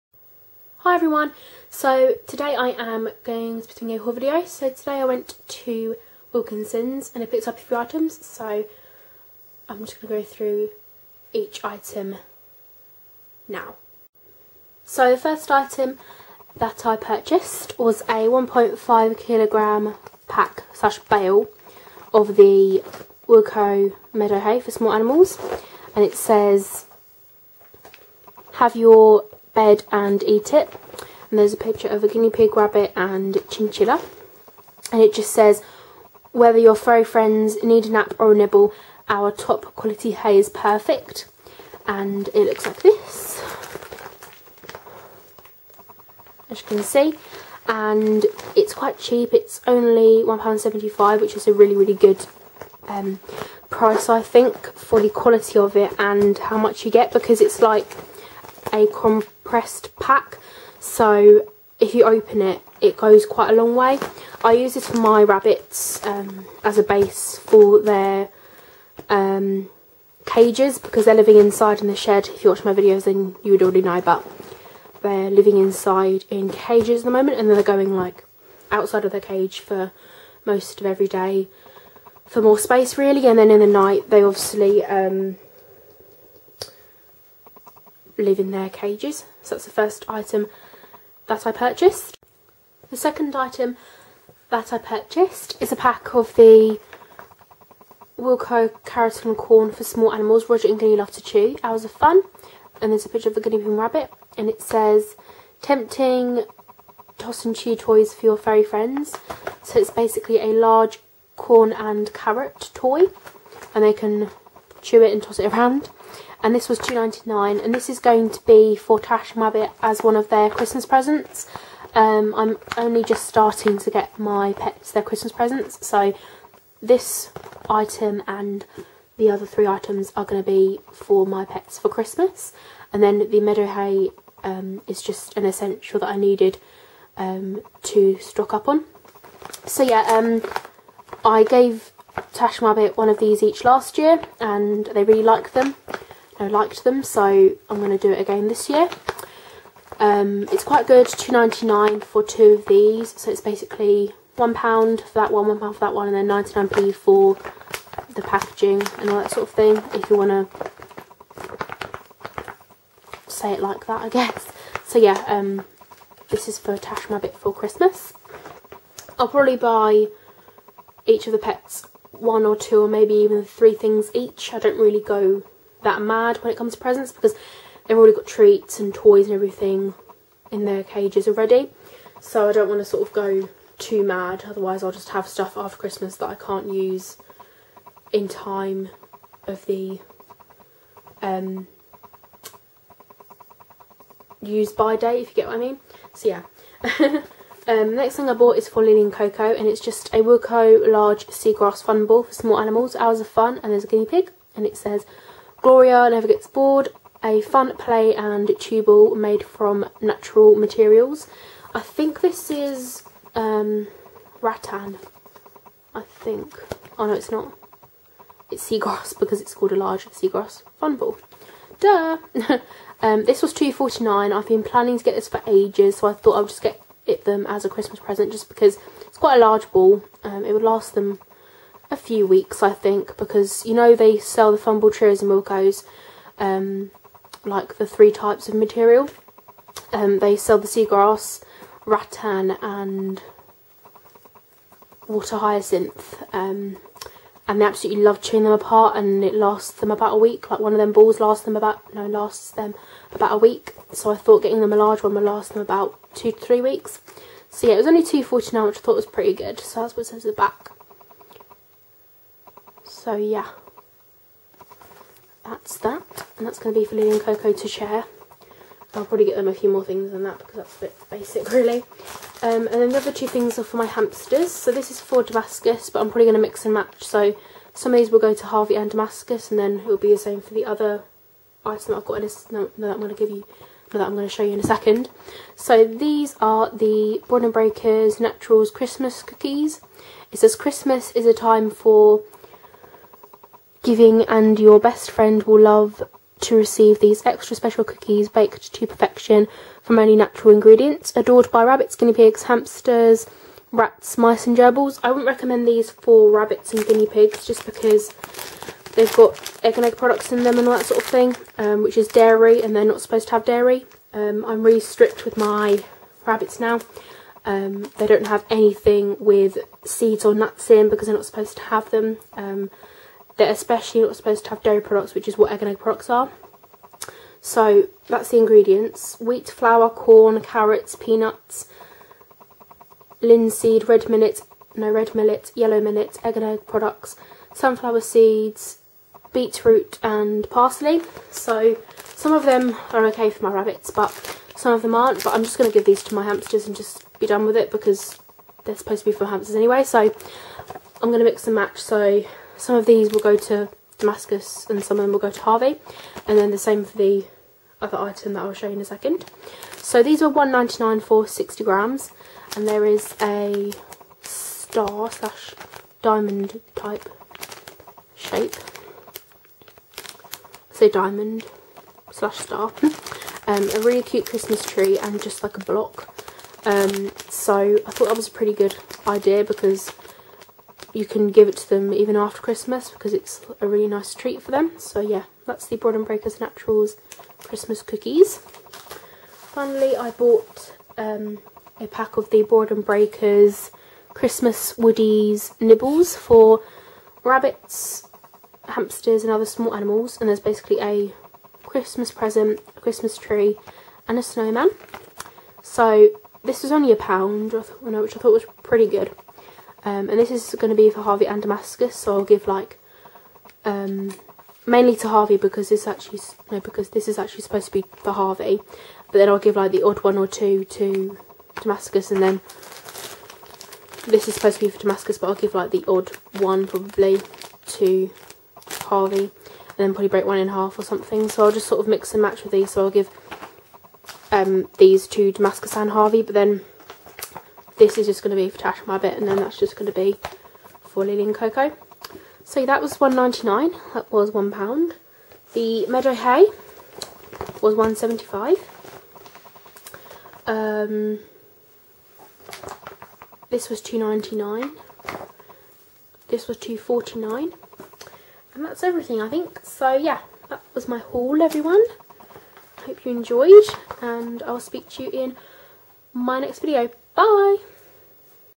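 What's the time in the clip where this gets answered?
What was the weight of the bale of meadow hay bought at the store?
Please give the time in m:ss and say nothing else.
0:18.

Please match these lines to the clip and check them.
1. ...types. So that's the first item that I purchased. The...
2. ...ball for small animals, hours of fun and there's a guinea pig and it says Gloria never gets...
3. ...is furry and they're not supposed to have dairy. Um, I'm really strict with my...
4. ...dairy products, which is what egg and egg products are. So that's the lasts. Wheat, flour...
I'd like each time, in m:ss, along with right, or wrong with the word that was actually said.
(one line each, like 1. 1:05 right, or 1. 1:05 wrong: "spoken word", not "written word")
1. 1:28 wrong: "cages", not "types"
2. 3:22 right
3. 5:11 wrong: "dairy", not "furry"
4. 5:24 wrong: "ingredients", not "lasts".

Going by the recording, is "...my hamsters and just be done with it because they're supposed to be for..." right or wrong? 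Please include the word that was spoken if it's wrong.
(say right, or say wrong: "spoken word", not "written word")
right.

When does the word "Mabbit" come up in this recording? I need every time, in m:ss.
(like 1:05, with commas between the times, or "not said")
1:59, 2:22.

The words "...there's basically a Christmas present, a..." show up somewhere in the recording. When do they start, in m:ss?
6:40.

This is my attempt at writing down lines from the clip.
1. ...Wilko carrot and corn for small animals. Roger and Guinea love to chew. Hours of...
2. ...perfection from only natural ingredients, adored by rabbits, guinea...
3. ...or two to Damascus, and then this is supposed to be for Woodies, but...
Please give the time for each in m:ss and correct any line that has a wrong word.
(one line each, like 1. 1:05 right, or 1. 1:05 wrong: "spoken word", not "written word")
1. 1:38 right
2. 4:58 right
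3. 7:00 wrong: "Damascus", not "Woodies".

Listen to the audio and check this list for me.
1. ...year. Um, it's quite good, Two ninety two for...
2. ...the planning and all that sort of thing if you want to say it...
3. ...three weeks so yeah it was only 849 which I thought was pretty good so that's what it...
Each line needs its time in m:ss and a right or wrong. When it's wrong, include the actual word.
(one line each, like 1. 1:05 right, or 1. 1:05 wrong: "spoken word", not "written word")
1. 2:28 wrong: "nine", not "two"
2. 2:38 wrong: "packaging", not "planning"
3. 4:16 wrong: "249", not "849".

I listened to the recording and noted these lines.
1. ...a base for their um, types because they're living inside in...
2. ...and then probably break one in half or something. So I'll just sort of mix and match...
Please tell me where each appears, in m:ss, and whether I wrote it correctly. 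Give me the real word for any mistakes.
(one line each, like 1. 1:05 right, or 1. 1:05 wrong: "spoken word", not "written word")
1. 1:06 wrong: "cages", not "types"
2. 7:09 right.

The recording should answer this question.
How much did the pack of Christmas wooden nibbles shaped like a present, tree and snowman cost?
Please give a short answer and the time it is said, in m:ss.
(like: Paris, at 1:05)
£1, at 6:46.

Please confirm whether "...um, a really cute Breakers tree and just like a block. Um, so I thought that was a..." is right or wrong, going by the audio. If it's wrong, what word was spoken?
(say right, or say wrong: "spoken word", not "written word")
wrong: "Christmas", not "Breakers".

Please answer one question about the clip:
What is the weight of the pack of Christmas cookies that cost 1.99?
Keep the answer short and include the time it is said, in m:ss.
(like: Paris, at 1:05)
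60 grams, at 6:01.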